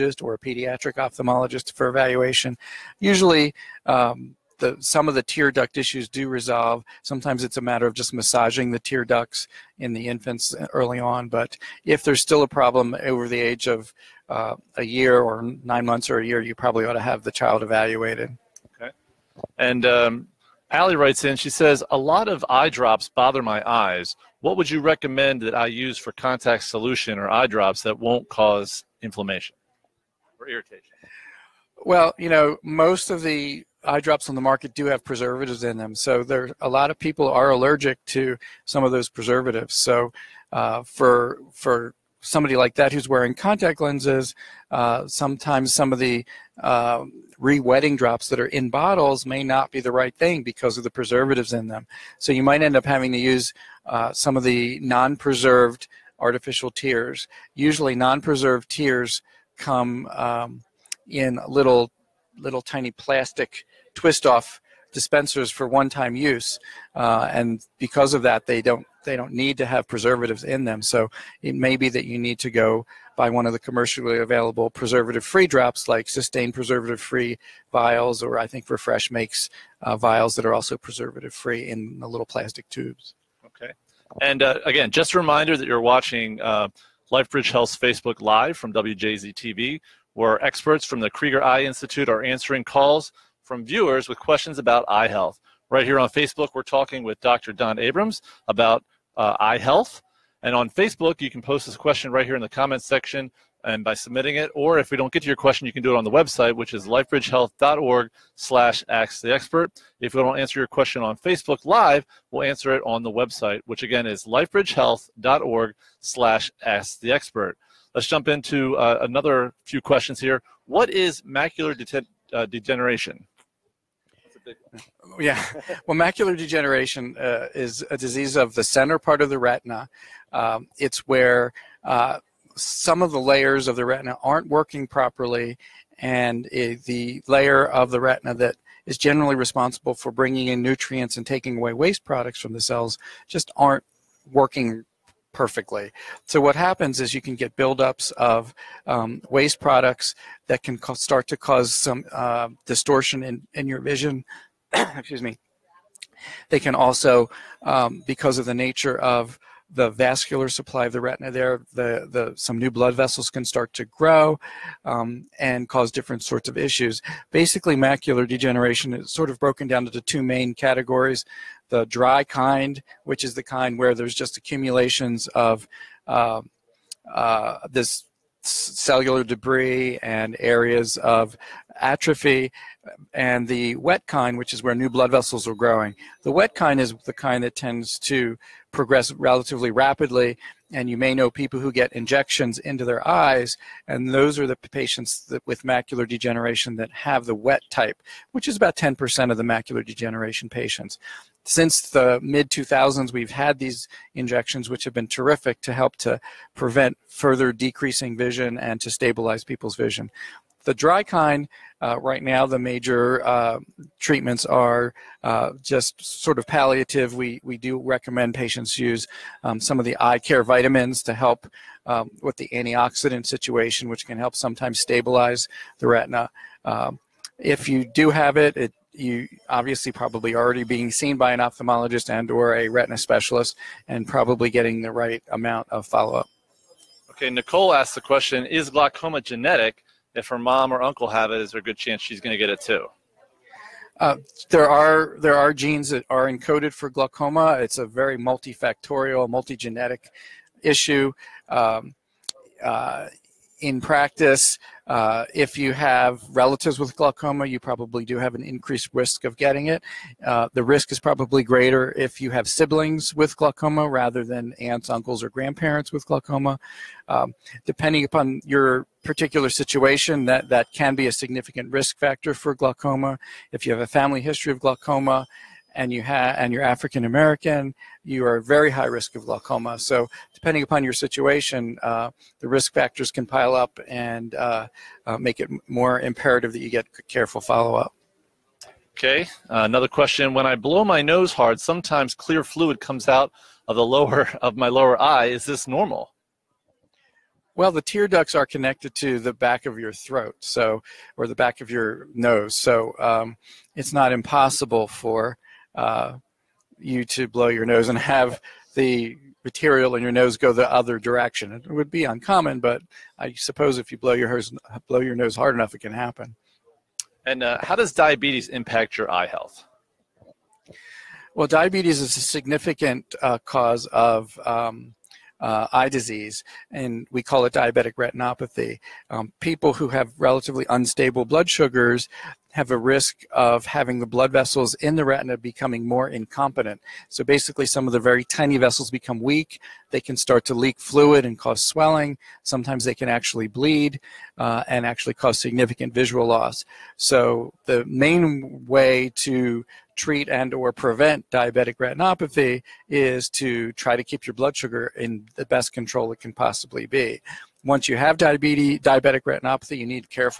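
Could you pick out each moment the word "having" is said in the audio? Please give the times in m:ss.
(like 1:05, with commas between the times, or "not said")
0:52, 5:33.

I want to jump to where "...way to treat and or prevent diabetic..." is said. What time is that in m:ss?
5:48.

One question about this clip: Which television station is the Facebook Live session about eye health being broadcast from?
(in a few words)
WJZ TV.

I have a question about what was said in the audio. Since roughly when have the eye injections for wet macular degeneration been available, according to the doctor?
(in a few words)
mid 2000s.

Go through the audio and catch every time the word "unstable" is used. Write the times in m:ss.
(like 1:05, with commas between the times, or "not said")
5:30.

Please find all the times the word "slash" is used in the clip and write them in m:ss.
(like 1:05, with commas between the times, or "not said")
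1:48, 1:56.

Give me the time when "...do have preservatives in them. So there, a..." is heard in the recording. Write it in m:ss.
0:34.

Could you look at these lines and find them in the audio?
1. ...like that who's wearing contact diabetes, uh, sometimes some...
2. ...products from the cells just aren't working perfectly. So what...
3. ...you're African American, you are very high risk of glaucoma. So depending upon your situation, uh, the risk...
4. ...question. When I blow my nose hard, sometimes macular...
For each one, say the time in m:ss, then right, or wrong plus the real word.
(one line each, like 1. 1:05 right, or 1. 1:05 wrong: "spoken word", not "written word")
1. 0:42 wrong: "lenses", not "diabetes"
2. 2:22 right
3. 4:36 right
4. 4:49 wrong: "clear", not "macular".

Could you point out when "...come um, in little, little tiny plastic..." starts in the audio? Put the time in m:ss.
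0:59.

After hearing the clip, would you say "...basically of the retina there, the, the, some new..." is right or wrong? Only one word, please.
wrong.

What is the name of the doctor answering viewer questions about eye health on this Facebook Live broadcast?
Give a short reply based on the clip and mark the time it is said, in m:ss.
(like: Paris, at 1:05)
Don Abrams, at 1:37.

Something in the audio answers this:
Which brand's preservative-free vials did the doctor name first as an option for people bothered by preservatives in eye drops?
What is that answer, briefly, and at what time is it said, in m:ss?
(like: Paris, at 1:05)
Systane, at 1:16.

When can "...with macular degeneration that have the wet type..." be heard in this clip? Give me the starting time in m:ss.
3:15.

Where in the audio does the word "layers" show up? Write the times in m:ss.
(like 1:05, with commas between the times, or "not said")
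2:13, 2:17.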